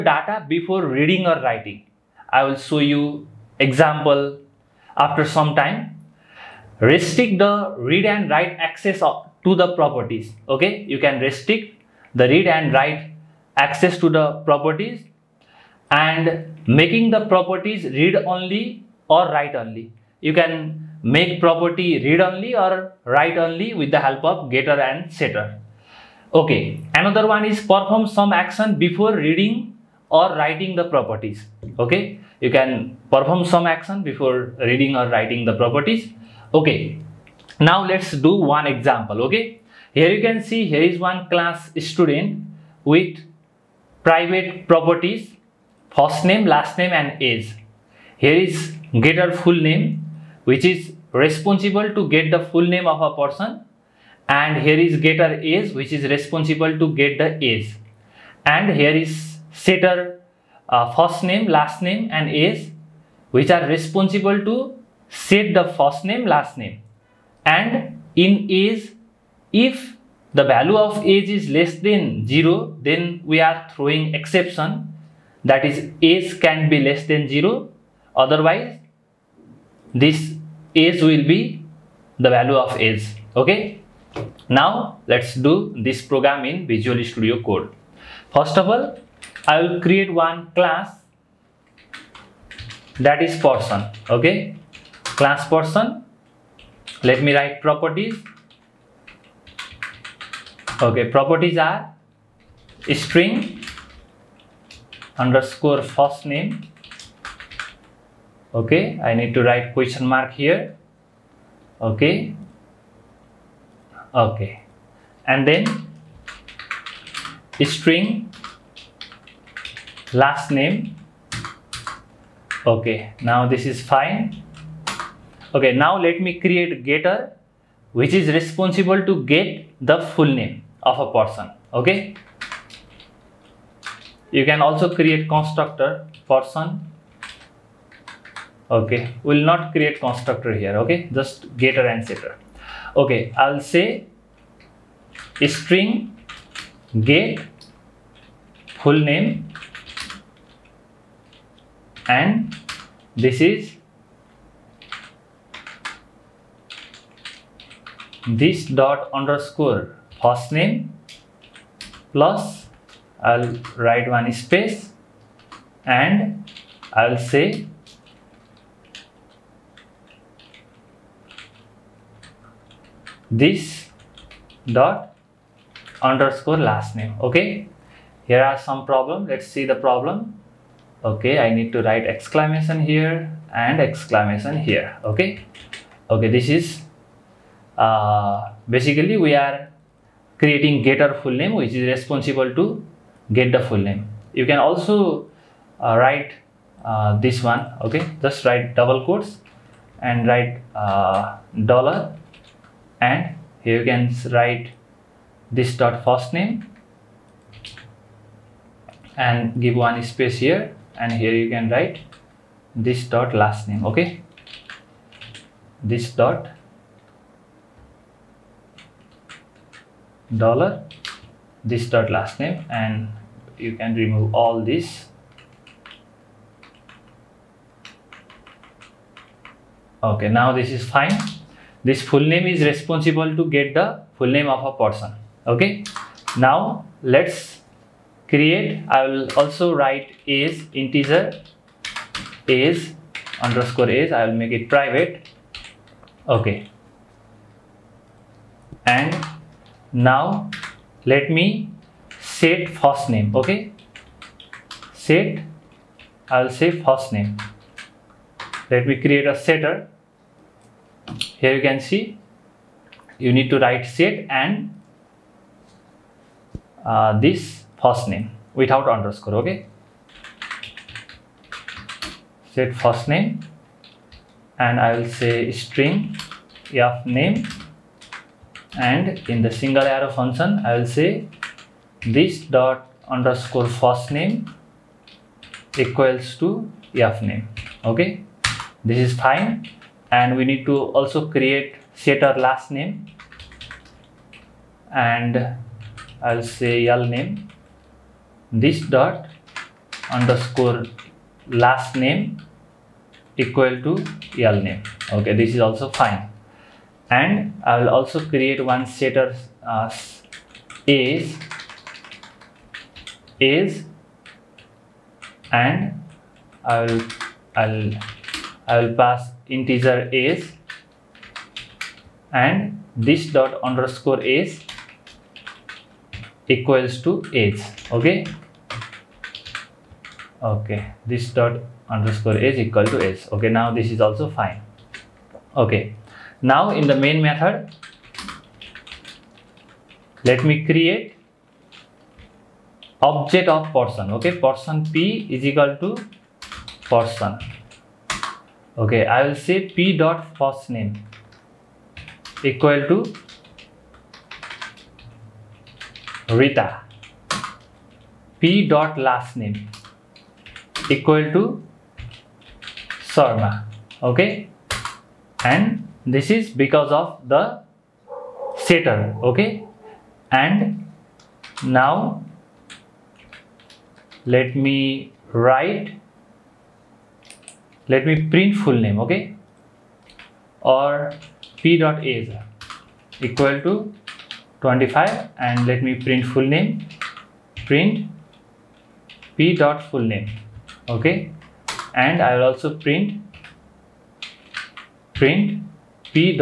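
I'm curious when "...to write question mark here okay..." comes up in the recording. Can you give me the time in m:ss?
1:49.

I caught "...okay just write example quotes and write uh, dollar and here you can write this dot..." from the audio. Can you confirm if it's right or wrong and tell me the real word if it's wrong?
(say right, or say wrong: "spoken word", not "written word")
wrong: "double", not "example".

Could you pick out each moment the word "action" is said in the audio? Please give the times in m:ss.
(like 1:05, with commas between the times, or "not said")
0:28, 0:33.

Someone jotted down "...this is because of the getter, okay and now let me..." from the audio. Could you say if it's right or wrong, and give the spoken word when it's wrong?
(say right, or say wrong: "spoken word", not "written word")
wrong: "setter", not "getter".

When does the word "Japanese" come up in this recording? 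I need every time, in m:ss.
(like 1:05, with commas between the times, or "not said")
not said.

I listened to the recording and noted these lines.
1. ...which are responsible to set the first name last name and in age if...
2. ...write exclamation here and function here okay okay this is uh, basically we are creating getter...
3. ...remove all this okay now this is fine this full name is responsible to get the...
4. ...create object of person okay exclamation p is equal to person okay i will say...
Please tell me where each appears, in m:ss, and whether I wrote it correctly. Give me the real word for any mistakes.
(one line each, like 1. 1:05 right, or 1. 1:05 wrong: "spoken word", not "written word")
1. 1:03 right
2. 3:01 wrong: "exclamation", not "function"
3. 3:43 right
4. 5:40 wrong: "person", not "exclamation".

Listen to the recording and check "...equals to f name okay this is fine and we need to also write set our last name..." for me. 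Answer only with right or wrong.
wrong.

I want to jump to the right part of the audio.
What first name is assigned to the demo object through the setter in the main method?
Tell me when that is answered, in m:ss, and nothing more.
5:56.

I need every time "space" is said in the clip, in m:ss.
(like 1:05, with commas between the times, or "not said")
2:44, 3:30.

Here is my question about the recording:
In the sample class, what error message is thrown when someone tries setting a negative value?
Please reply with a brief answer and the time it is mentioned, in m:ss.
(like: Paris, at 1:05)
age can be less than 0, at 1:16.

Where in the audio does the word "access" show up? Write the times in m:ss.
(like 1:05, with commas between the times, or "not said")
0:08, 0:13.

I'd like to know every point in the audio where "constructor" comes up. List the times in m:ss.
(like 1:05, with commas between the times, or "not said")
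2:15, 2:19.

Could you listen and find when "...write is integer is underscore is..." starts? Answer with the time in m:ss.
3:59.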